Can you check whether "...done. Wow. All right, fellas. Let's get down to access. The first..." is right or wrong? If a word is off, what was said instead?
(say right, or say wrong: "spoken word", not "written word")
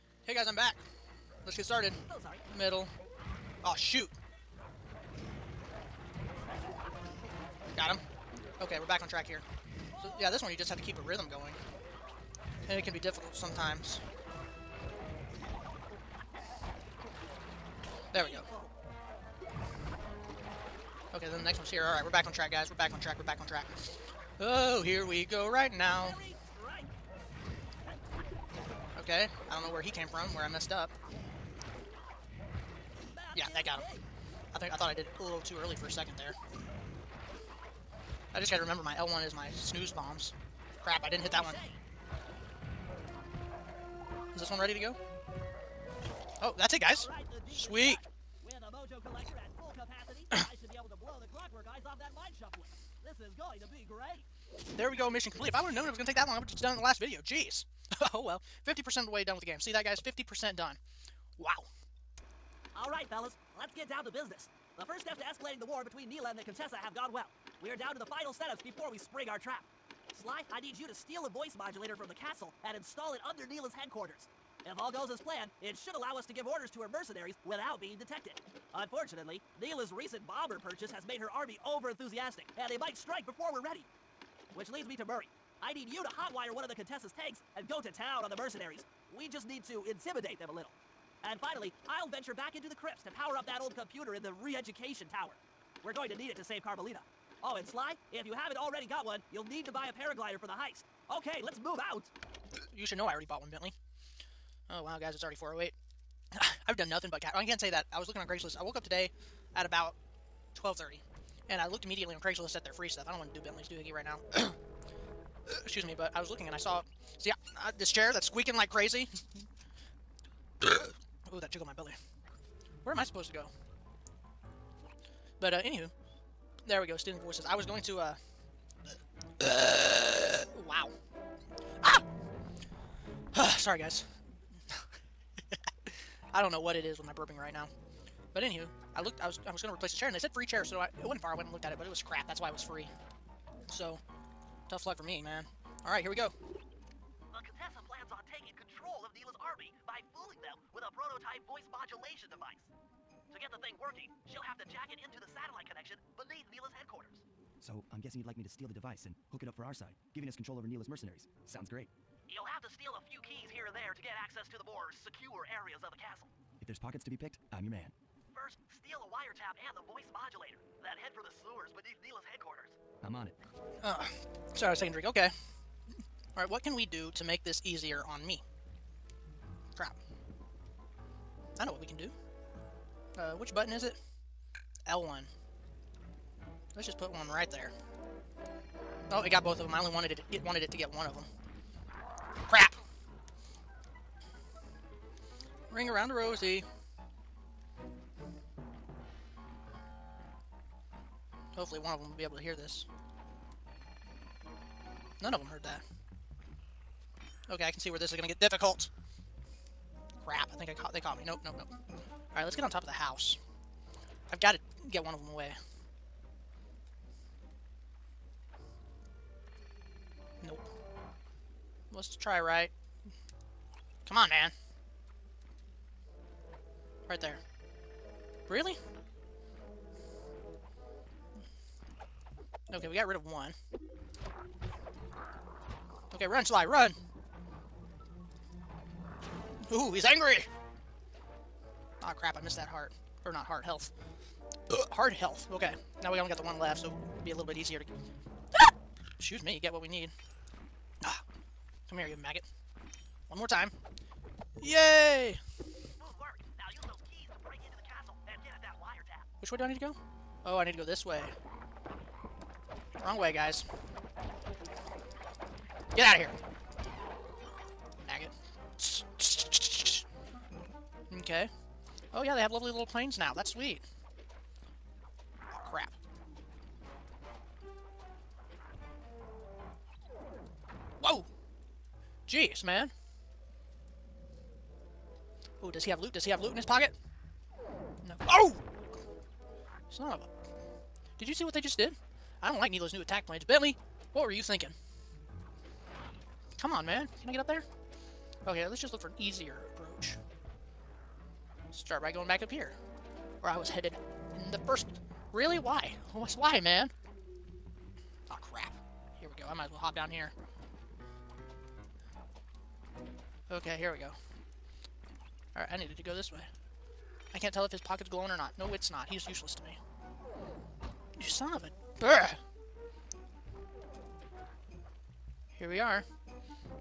wrong: "business", not "access".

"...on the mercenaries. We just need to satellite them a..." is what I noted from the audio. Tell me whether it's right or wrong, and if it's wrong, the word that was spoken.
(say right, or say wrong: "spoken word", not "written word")
wrong: "intimidate", not "satellite".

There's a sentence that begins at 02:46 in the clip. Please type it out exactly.
If there's pockets to be picked, I'm your man.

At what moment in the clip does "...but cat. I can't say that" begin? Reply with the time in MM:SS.
01:47.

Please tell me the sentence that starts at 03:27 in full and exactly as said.
Okay, I can see where this is going to get difficult.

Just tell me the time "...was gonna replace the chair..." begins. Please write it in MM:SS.
02:19.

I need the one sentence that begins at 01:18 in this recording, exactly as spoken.
Unfortunately, Neyla's recent bomber purchase has made her army over-enthusiastic, and they might strike before we're ready.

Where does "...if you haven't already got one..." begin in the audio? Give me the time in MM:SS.
01:38.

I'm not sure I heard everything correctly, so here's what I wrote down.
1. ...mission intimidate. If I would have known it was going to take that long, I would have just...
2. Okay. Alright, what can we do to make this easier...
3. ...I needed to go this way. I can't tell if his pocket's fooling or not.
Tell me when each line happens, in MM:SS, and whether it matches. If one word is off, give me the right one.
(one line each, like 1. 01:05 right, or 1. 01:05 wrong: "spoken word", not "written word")
1. 00:55 wrong: "complete", not "intimidate"
2. 02:55 right
3. 05:15 wrong: "glowing", not "fooling".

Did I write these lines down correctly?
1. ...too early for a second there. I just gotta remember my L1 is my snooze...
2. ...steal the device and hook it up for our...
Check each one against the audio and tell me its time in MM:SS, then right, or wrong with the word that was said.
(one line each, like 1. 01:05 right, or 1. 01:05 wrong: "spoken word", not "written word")
1. 00:35 right
2. 02:38 right.